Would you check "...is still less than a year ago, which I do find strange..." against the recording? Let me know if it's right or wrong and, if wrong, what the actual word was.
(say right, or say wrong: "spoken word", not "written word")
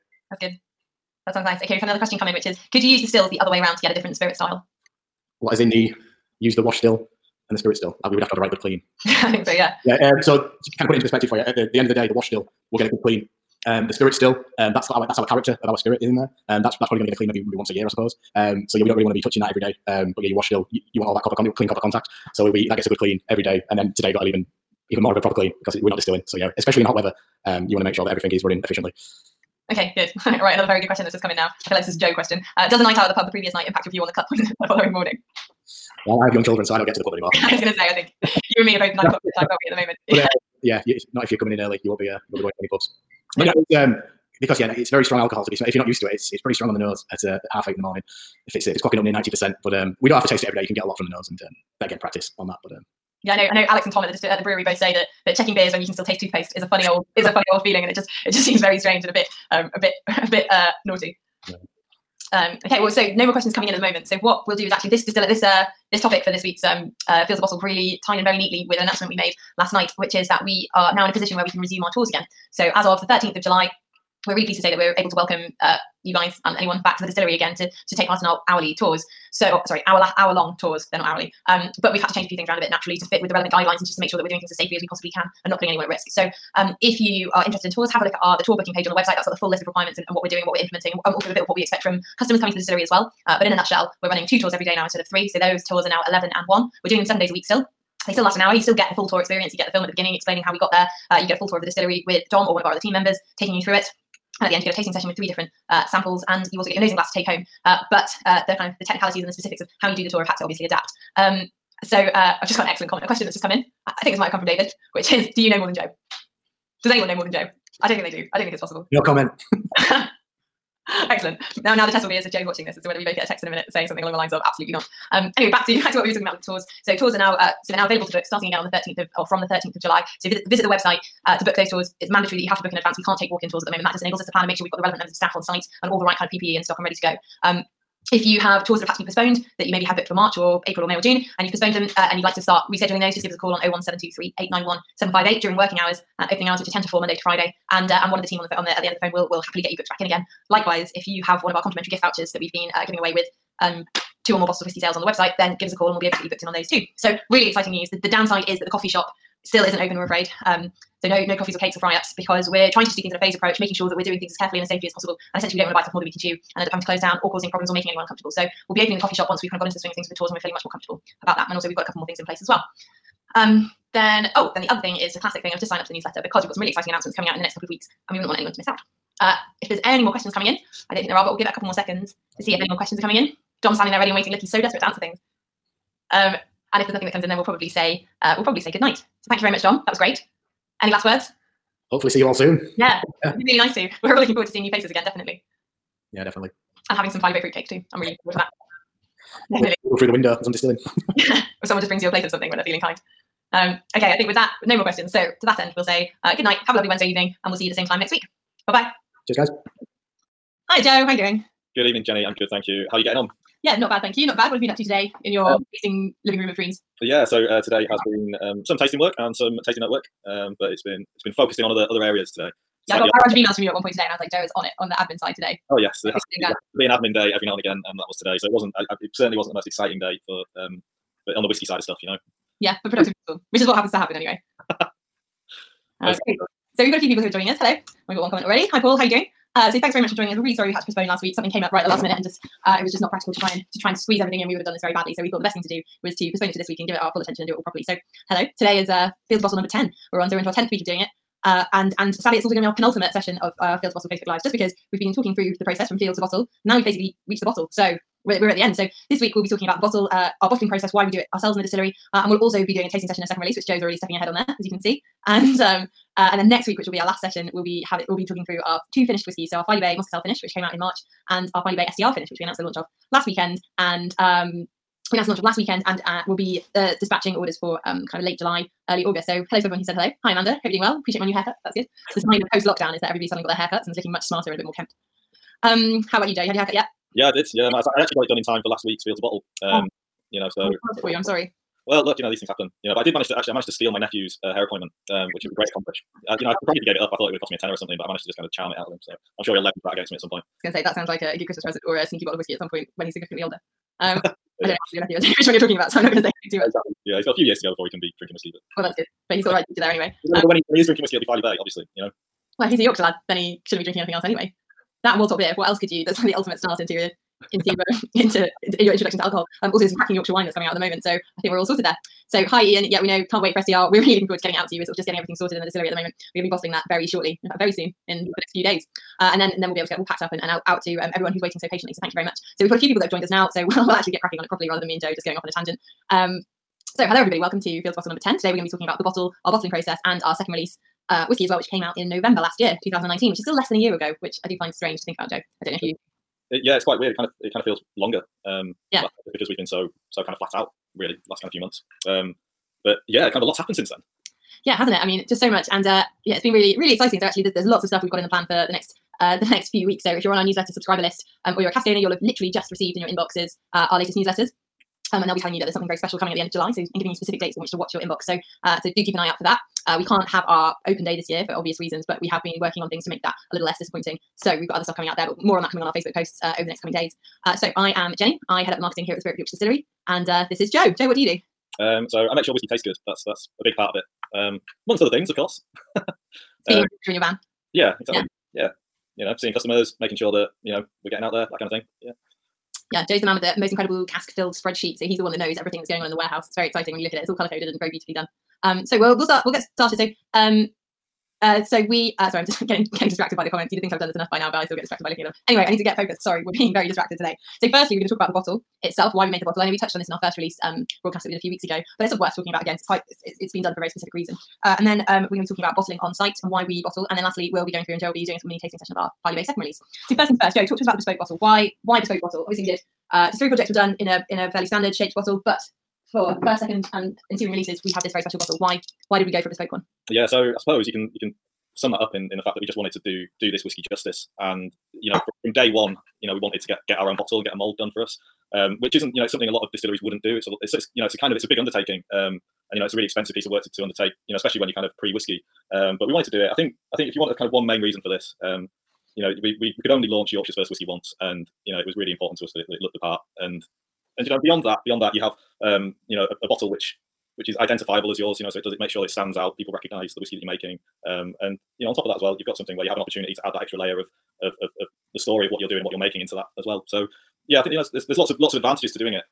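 right.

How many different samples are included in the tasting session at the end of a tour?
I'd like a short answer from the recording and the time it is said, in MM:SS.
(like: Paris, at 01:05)
3, at 01:45.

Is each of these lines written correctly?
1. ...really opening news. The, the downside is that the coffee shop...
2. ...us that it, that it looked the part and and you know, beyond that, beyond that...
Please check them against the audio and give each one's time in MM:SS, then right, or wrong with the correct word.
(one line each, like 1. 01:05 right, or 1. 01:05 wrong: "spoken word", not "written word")
1. 02:37 wrong: "exciting", not "opening"
2. 07:32 right.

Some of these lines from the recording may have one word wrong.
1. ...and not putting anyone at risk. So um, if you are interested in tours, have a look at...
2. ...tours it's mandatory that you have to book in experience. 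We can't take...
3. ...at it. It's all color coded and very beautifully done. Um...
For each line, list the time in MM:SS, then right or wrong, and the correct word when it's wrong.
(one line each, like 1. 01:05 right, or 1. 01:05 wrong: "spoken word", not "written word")
1. 01:25 right
2. 02:11 wrong: "advance", not "experience"
3. 06:37 right.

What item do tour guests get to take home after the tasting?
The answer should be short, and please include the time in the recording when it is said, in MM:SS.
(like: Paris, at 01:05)
nosing glass, at 01:46.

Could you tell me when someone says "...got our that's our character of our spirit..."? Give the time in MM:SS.
00:14.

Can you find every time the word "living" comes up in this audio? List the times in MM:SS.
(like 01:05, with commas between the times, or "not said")
03:36.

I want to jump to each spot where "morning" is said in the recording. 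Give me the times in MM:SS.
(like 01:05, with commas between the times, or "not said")
00:34, 00:47.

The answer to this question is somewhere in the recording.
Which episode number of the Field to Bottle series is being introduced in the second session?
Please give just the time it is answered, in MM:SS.
04:09.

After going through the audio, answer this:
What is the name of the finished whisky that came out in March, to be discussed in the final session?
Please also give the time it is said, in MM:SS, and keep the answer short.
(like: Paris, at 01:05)
Filey Bay Muscatel finish, at 04:29.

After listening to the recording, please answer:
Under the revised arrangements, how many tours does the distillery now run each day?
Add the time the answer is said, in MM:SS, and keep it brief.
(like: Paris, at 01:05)
2, at 01:34.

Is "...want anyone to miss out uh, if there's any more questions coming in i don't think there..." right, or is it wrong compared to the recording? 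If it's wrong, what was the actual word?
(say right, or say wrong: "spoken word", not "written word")
right.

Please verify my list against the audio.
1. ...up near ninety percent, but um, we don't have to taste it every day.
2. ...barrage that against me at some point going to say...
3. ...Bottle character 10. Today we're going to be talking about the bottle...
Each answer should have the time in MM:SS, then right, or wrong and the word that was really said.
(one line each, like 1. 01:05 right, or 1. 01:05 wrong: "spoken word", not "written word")
1. 00:48 right
2. 04:59 wrong: "leverage", not "barrage"
3. 05:37 wrong: "number", not "character".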